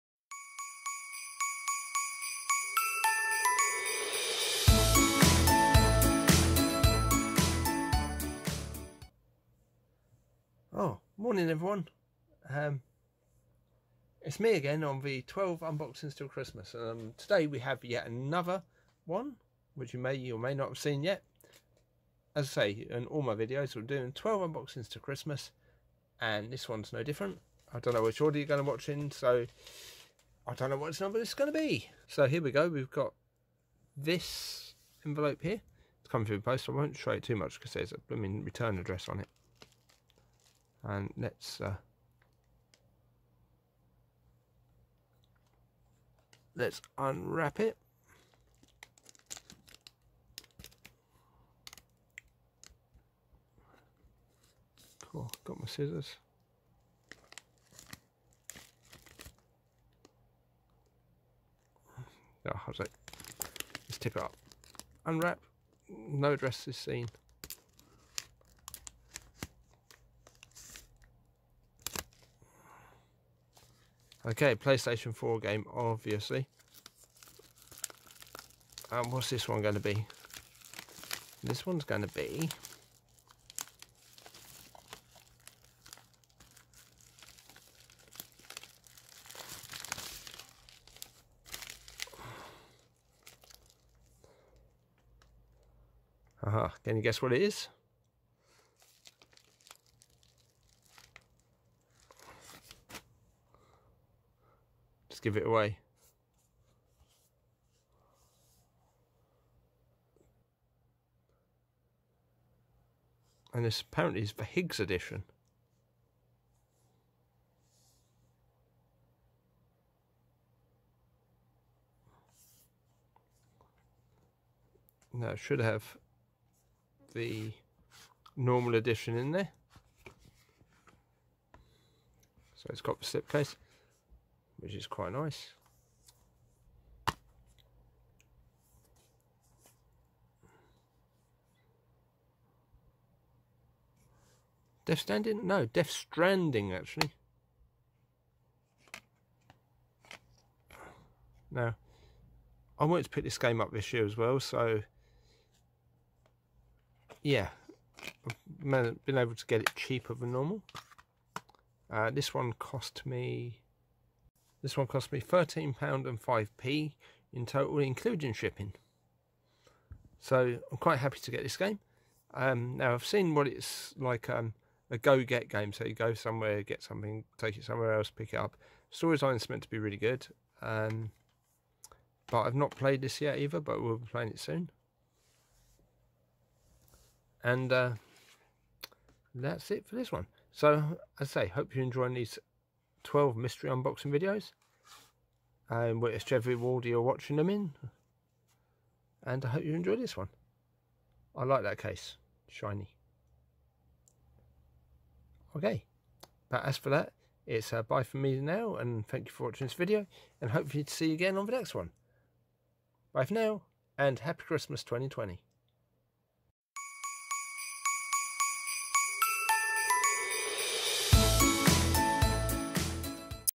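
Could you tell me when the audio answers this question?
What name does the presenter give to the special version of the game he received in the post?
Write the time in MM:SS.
01:54.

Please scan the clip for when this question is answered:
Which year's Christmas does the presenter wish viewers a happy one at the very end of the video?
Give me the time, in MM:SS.
03:34.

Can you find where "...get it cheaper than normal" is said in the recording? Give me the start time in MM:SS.
02:39.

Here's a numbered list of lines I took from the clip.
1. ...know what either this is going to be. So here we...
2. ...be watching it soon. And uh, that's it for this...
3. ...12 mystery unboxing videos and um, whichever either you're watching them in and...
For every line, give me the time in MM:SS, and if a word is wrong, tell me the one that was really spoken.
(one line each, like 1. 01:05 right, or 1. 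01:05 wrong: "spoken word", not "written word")
1. 00:30 wrong: "number", not "either"
2. 03:03 wrong: "playing", not "watching"
3. 03:13 wrong: "order", not "either".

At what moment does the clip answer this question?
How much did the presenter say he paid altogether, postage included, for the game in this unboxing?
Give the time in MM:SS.
02:45.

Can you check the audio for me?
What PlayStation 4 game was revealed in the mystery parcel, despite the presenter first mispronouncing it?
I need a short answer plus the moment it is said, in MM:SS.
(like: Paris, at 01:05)
Death Stranding, at 02:25.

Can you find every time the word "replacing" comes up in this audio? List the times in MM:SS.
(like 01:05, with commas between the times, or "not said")
not said.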